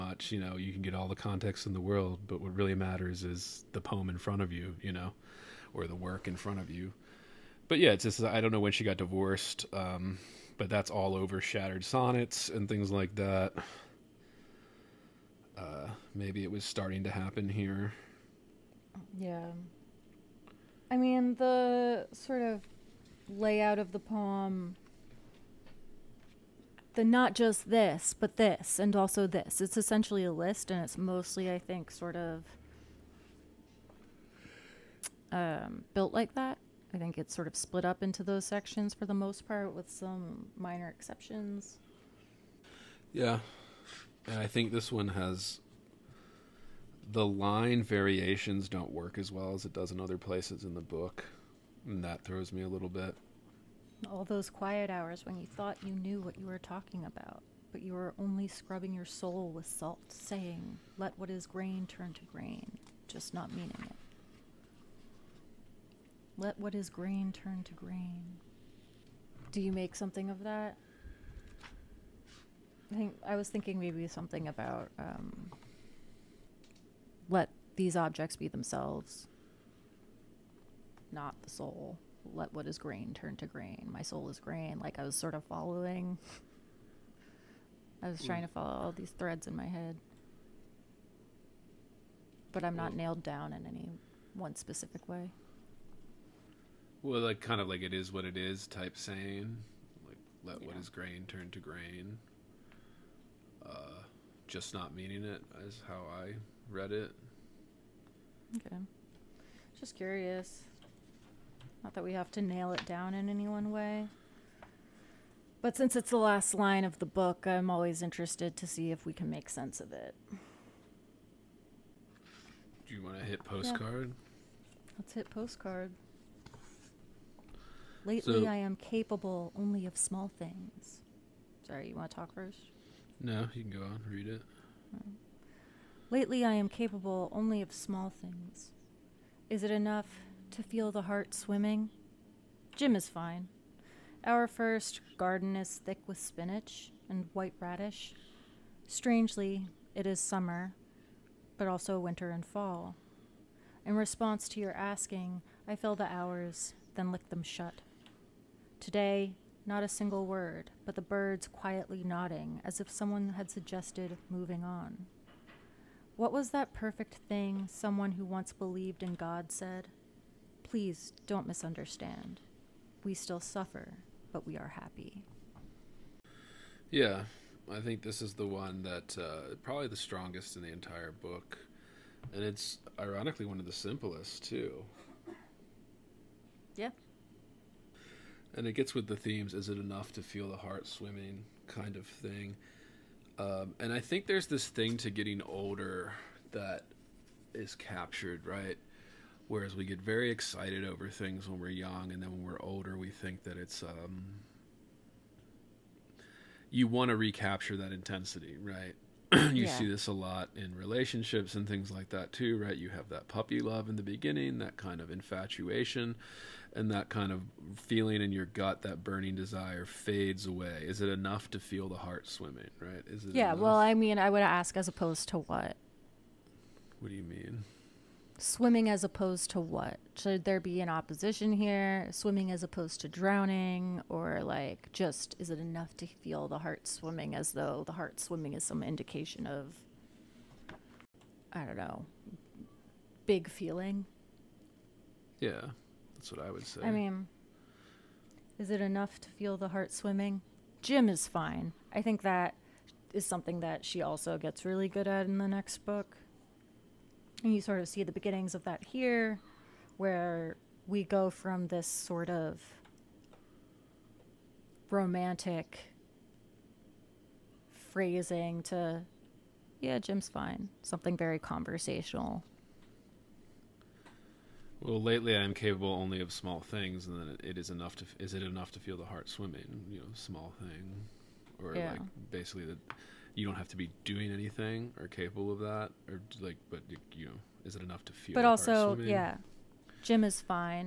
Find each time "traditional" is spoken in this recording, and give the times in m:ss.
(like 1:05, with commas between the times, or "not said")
not said.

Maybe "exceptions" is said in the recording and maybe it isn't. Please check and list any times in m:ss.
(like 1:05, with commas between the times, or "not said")
0:40.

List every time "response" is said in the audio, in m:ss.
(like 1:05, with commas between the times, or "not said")
2:33.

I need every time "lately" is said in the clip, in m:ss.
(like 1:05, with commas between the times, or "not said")
2:08, 2:16, 4:35.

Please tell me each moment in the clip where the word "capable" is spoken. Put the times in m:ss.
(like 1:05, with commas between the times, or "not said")
2:08, 2:16, 4:35, 4:45.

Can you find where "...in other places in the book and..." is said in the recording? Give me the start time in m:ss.
0:49.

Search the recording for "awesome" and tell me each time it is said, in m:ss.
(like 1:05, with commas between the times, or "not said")
not said.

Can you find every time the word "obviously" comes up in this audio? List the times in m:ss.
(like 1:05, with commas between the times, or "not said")
not said.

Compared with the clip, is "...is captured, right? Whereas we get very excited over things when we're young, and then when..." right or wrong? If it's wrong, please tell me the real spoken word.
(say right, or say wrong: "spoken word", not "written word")
right.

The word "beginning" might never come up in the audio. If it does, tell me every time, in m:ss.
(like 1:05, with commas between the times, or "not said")
3:34, 4:18.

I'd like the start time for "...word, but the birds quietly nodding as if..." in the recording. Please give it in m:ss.
2:40.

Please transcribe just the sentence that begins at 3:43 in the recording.
well, I mean, I would ask as opposed to what?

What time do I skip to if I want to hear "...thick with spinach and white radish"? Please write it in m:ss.
2:25.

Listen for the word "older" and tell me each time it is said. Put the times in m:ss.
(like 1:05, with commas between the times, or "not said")
3:15, 3:22.